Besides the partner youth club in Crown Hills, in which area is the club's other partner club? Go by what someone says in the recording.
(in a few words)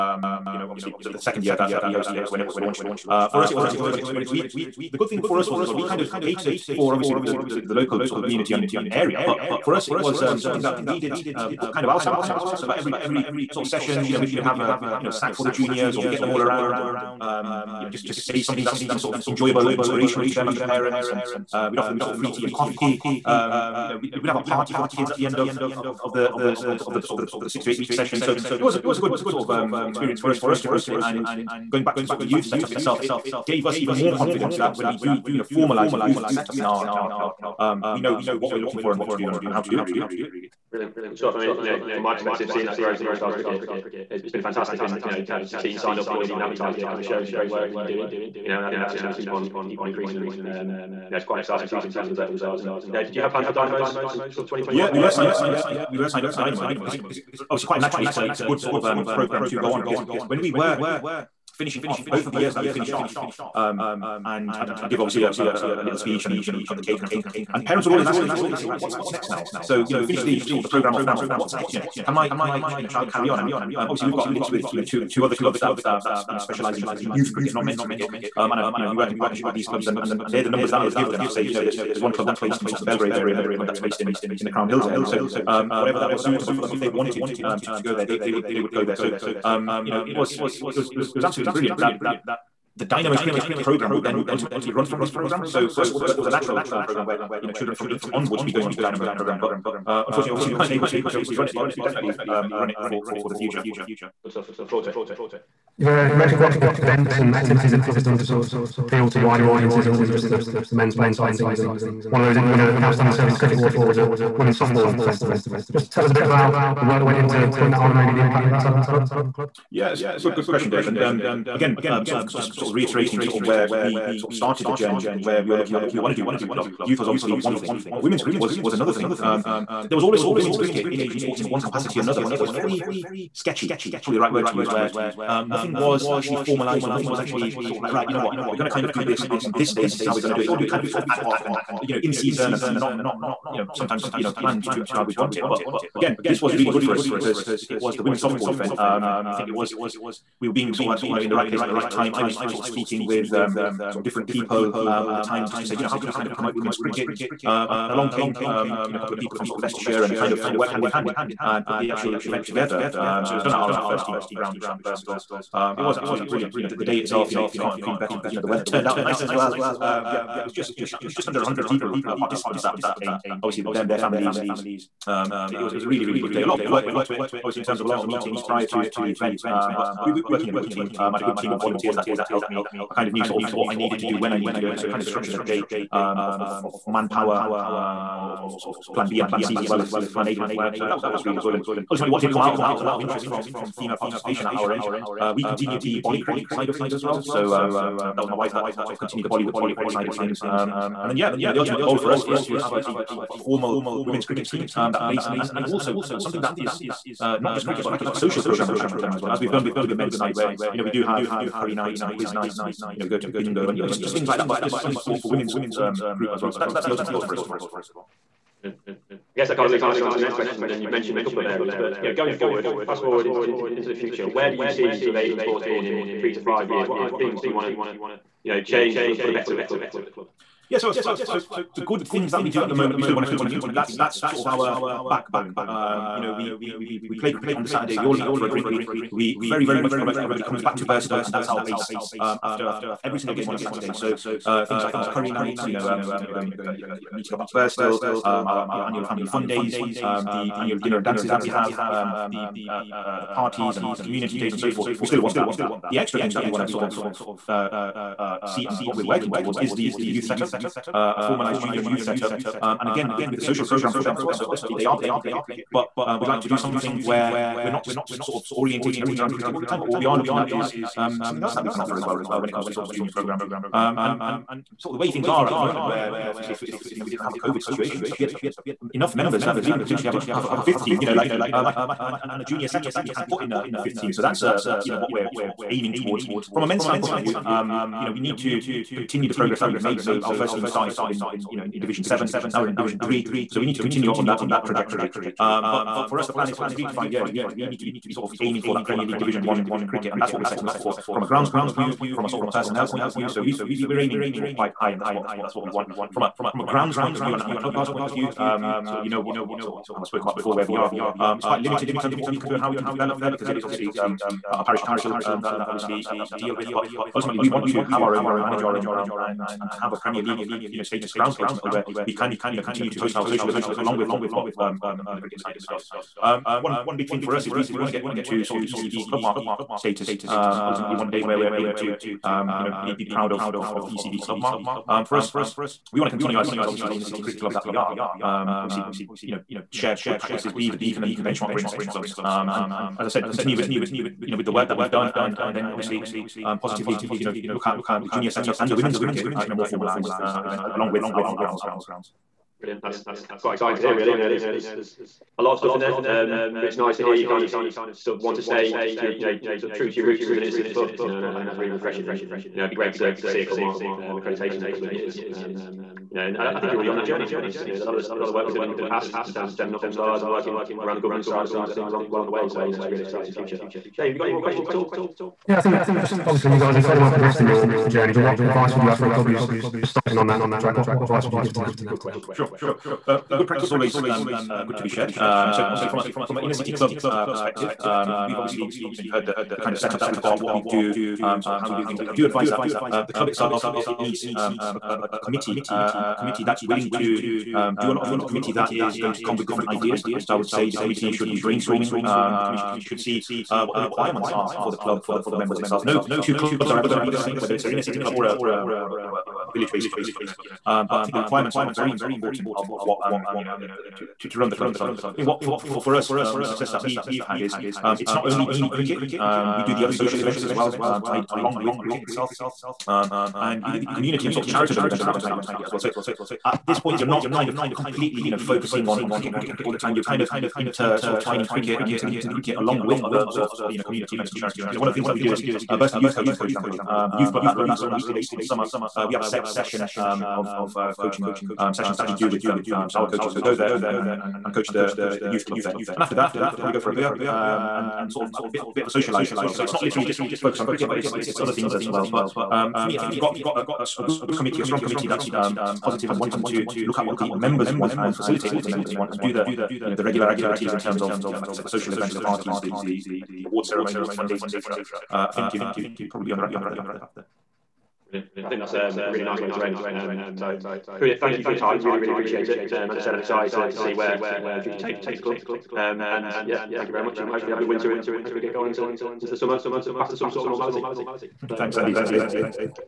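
Belgrave.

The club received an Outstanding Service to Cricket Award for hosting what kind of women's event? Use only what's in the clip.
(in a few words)
Women's Softball Festival.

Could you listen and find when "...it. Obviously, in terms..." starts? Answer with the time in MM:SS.
02:57.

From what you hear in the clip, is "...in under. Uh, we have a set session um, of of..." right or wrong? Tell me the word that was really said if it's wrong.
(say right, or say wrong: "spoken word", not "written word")
wrong: "summer", not "under".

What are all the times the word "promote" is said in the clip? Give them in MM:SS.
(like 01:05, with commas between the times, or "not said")
02:36, 03:59.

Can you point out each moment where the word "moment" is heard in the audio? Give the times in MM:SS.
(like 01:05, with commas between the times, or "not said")
03:52, 04:35.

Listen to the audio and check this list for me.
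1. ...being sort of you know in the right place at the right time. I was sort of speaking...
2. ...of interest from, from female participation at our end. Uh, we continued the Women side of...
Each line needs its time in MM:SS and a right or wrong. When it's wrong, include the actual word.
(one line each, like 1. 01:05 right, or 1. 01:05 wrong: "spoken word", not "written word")
1. 02:30 right
2. 03:12 wrong: "Bollycrick", not "Women".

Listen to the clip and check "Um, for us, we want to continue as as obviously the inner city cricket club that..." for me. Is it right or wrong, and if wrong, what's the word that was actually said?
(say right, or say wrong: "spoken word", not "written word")
right.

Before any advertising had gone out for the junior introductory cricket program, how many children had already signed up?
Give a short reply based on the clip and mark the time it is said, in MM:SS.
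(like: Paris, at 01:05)
16, at 00:45.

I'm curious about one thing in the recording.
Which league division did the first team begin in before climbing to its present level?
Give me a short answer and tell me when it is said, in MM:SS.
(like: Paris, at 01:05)
Division Seven, at 04:51.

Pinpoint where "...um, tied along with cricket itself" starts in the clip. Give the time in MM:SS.
07:00.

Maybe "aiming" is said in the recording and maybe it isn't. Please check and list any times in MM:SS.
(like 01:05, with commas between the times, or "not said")
04:45, 04:58, 05:04.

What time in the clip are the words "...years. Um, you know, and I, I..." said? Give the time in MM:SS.
06:04.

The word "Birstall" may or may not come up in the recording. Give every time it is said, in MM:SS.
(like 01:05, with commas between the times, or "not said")
02:44, 04:00, 04:07.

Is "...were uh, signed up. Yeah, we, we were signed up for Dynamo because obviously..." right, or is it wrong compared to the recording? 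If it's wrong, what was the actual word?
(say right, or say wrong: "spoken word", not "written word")
right.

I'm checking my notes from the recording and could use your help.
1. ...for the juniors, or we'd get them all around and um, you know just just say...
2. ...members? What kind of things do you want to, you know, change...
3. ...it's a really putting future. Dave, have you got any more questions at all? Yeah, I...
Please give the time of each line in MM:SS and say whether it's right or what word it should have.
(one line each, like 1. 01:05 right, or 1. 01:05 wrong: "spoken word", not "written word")
1. 00:15 right
2. 03:46 wrong: "years", not "members"
3. 06:12 wrong: "exciting", not "putting".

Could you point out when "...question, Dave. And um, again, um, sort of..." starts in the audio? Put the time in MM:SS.
02:00.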